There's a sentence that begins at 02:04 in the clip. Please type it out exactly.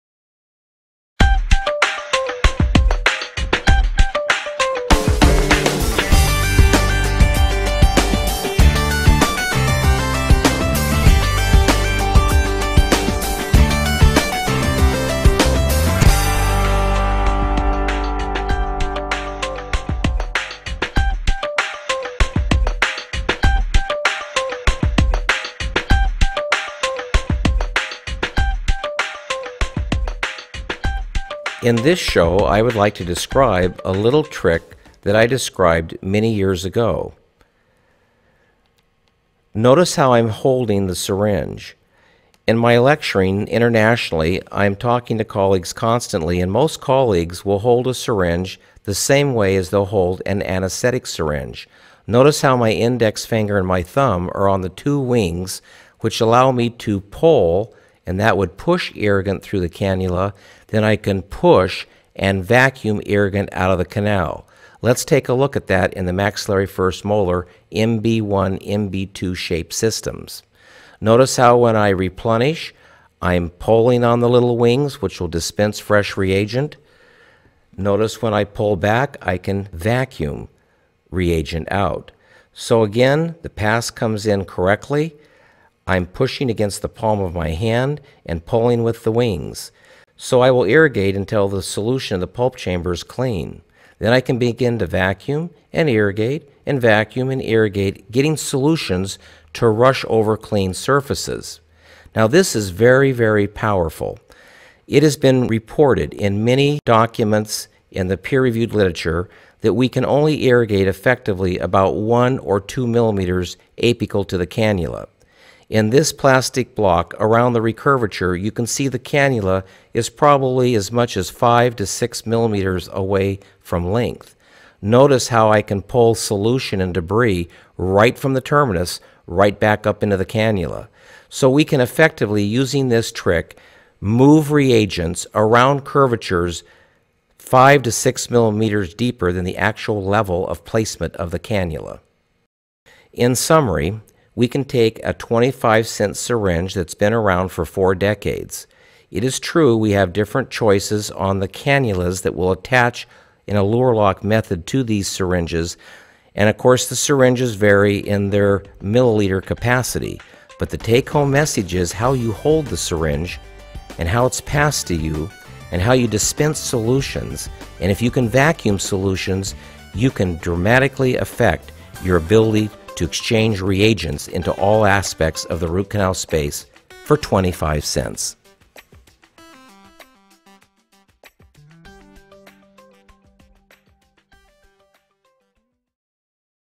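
Notice how I can pull solution and debris right from the terminus right back up into the cannula.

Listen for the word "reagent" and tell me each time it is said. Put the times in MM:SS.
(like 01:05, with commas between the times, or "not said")
01:16, 01:21, 02:14, 02:53.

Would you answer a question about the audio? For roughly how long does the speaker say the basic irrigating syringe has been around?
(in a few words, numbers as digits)
4 decades.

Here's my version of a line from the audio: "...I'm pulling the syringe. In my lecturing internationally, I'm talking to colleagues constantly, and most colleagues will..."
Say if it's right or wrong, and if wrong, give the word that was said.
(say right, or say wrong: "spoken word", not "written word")
wrong: "holding", not "pulling".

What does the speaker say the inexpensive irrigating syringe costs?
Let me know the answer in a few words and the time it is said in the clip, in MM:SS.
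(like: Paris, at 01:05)
25 cents, at 02:25.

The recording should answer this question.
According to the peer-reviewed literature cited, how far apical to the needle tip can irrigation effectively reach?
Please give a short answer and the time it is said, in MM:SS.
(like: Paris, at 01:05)
1 or 2 millimeters, at 01:51.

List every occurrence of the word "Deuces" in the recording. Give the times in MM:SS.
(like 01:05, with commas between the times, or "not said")
not said.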